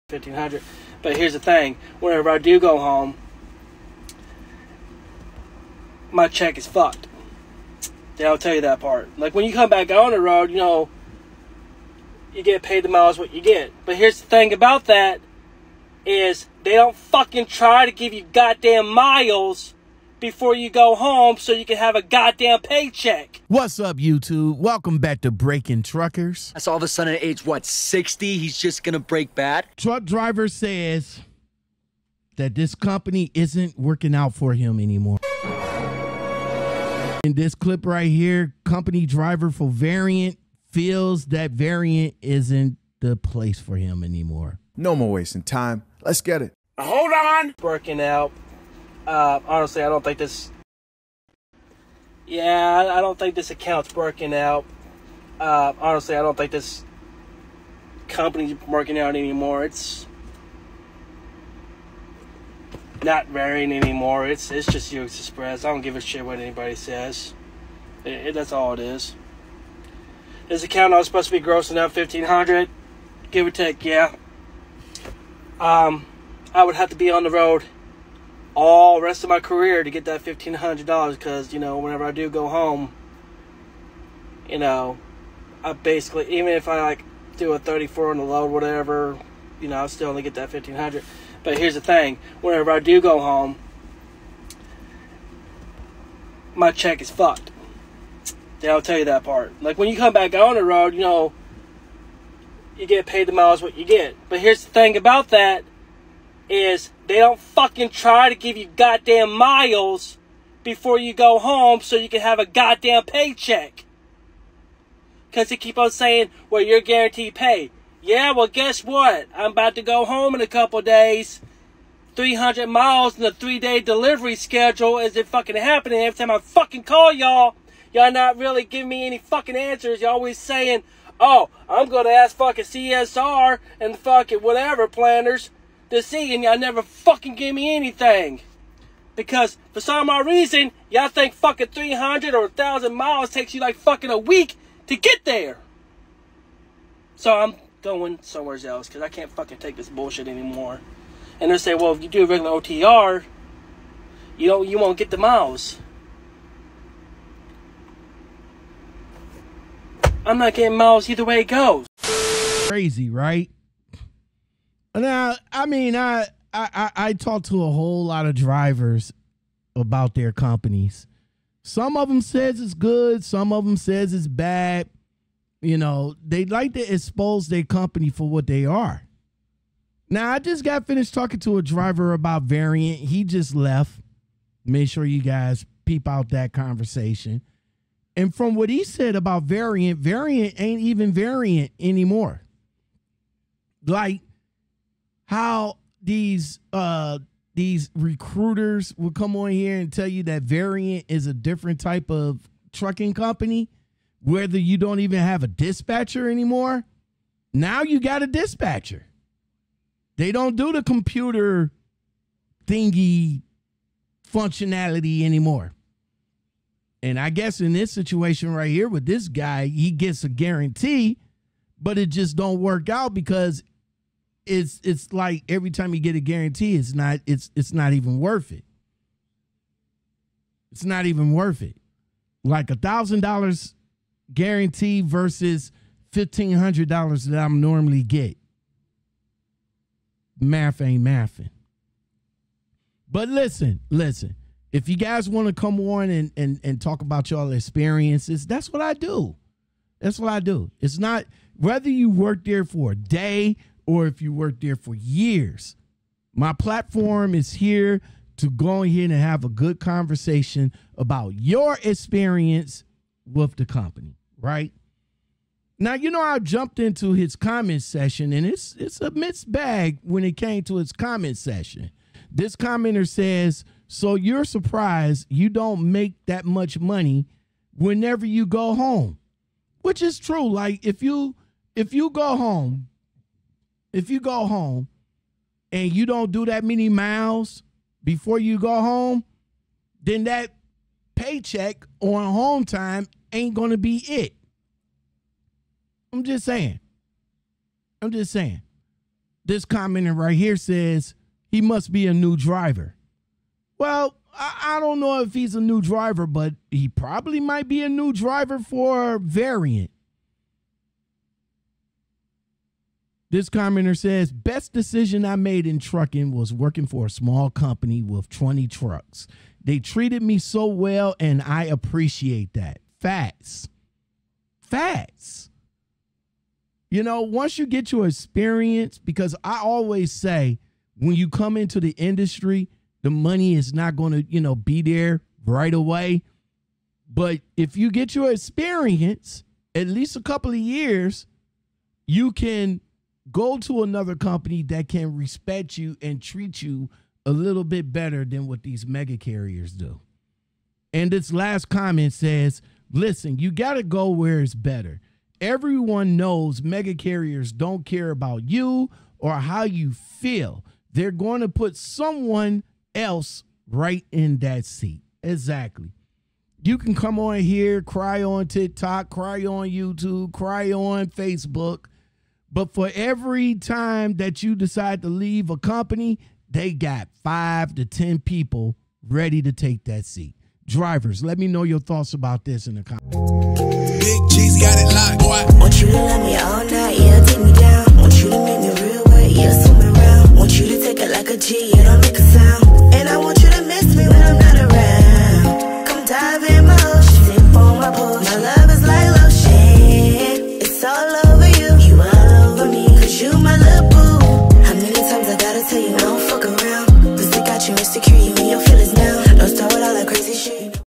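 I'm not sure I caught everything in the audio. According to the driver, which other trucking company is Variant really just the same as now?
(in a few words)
U.S. Xpress.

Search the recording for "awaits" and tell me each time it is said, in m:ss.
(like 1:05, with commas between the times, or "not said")
not said.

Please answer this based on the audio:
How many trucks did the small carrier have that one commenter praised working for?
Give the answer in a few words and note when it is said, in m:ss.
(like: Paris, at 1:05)
20, at 5:18.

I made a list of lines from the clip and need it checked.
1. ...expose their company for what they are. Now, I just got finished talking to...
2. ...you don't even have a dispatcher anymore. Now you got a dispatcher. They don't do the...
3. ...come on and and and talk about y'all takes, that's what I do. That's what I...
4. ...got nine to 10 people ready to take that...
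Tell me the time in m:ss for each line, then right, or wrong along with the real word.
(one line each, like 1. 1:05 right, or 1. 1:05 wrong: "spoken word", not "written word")
1. 2:56 right
2. 3:24 right
3. 4:05 wrong: "experiences", not "takes"
4. 6:16 wrong: "five", not "nine".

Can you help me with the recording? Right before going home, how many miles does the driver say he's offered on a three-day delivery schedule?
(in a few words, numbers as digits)
300.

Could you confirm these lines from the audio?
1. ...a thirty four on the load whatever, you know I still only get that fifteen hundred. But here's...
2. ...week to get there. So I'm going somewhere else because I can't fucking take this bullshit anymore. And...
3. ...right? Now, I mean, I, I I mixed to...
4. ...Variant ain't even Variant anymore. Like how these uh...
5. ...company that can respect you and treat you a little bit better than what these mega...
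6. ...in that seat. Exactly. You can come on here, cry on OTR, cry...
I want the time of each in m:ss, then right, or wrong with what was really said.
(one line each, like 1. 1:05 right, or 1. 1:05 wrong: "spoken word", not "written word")
1. 1:27 right
2. 2:24 right
3. 2:43 wrong: "talked", not "mixed"
4. 3:09 right
5. 5:44 right
6. 6:04 wrong: "TikTok", not "OTR".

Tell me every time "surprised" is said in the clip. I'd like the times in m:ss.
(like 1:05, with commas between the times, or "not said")
4:34.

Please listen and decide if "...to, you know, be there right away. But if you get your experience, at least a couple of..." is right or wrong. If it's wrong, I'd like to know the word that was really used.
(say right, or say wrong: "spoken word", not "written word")
right.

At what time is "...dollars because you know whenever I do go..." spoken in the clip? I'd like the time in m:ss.
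1:20.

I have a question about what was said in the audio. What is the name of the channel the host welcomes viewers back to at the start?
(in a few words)
Breaking Truckers.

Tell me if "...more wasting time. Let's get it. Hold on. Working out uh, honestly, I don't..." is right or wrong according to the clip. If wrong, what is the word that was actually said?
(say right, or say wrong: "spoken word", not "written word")
right.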